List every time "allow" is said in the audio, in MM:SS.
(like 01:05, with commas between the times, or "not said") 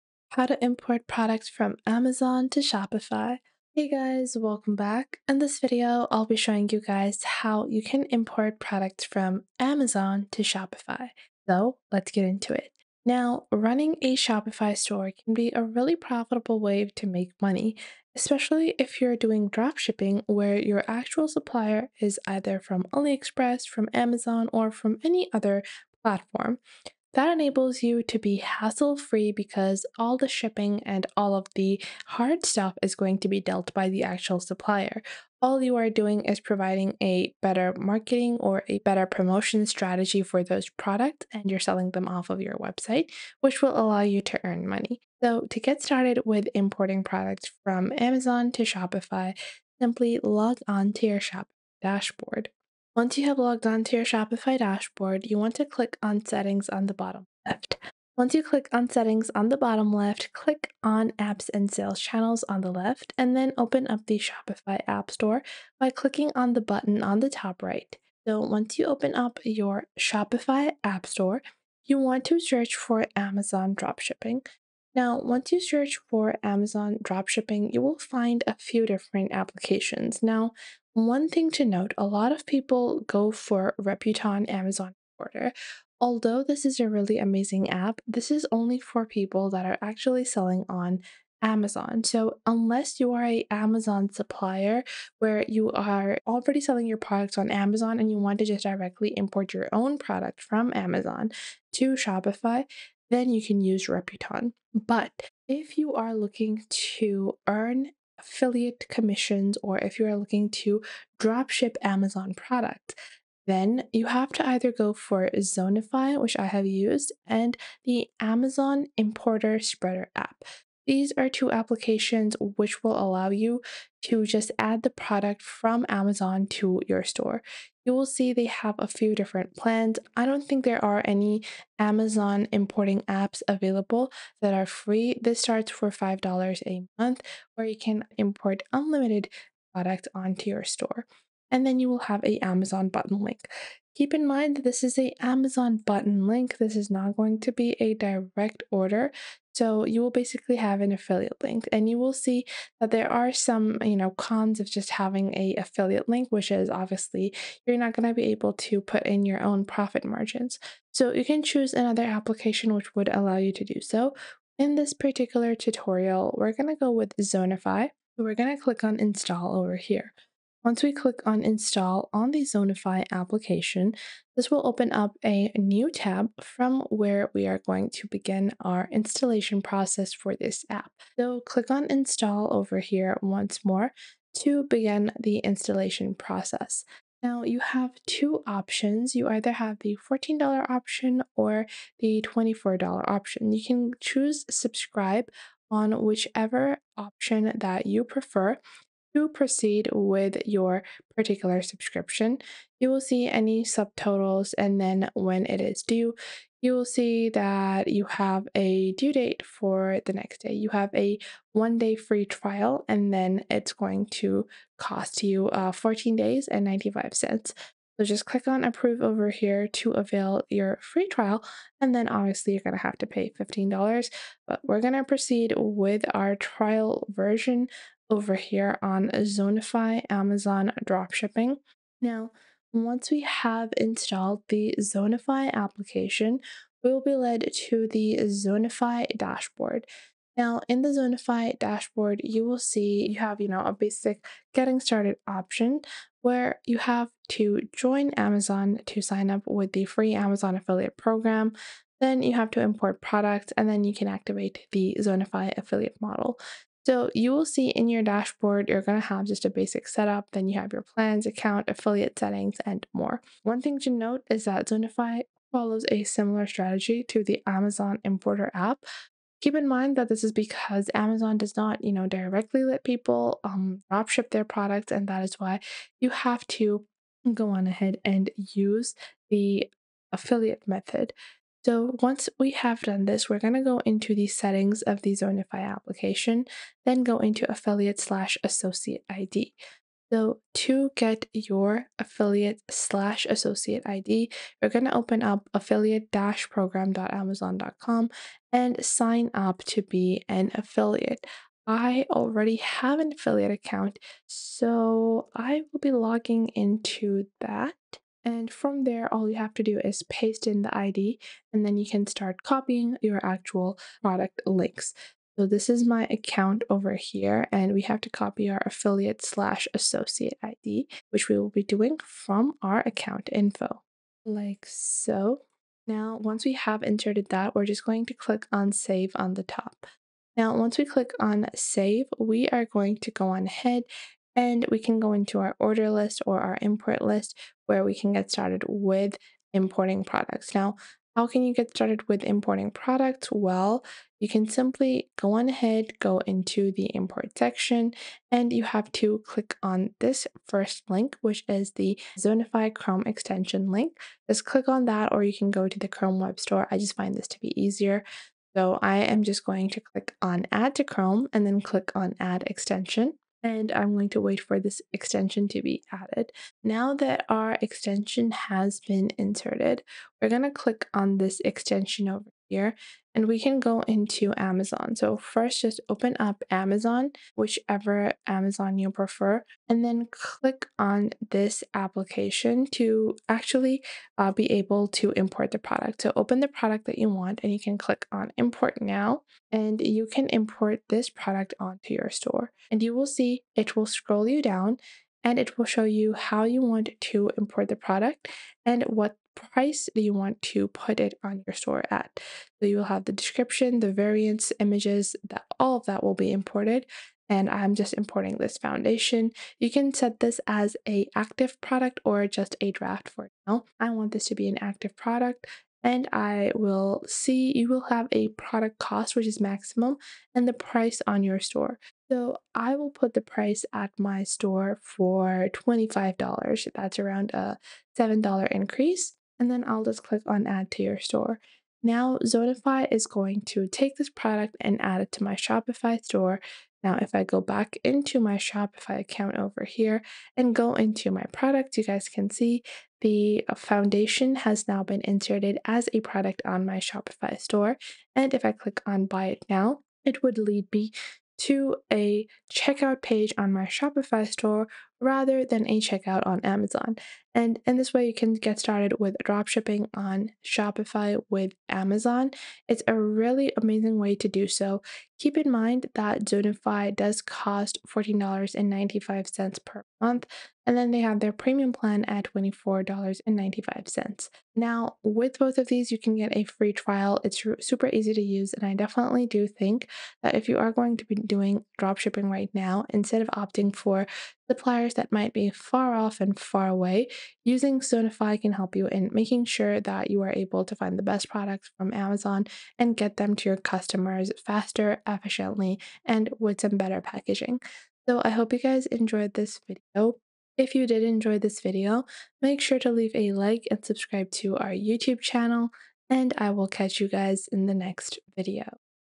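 00:43, 02:02, 02:43.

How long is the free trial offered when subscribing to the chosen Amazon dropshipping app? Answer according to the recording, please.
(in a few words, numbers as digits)
one day.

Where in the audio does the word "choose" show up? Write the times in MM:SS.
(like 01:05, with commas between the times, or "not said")
02:41, 03:13.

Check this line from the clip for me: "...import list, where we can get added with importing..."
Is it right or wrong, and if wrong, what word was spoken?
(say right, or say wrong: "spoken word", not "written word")
wrong: "started", not "added".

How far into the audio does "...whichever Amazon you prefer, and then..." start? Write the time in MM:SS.
06:17.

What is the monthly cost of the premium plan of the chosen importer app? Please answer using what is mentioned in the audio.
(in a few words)
$24.95.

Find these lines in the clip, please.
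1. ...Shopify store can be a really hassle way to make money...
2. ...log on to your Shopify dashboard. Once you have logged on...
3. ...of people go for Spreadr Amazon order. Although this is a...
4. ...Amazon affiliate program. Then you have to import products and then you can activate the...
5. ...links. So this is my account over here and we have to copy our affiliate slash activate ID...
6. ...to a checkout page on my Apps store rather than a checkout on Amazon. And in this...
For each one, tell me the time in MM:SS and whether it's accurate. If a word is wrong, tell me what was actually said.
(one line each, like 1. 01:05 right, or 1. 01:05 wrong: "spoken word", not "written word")
1. 00:14 wrong: "profitable", not "hassle"
2. 00:50 right
3. 01:22 wrong: "Reputon", not "Spreadr"
4. 04:10 right
5. 05:14 wrong: "associate", not "activate"
6. 07:31 wrong: "Shopify", not "Apps".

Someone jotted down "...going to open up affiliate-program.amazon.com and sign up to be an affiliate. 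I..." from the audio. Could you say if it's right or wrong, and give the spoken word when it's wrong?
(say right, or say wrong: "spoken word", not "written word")
right.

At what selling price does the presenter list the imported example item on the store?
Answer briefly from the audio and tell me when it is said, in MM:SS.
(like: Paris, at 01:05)
$25, at 07:05.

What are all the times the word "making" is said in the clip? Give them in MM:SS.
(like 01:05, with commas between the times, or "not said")
08:09.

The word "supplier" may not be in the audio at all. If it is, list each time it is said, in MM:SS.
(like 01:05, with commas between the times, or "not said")
00:21, 00:34, 01:34, 08:04.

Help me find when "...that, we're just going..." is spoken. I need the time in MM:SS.
05:27.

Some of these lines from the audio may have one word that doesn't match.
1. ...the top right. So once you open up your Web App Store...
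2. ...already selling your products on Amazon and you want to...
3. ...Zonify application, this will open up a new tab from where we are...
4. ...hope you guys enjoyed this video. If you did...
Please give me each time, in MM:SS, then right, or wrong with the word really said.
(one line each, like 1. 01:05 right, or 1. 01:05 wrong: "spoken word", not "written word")
1. 01:07 wrong: "Shopify", not "Web"
2. 01:36 right
3. 02:52 right
4. 08:18 right.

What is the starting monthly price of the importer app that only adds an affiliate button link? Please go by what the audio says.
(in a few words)
$5.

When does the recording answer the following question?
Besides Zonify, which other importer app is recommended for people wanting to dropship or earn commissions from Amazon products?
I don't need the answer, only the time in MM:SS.
01:58.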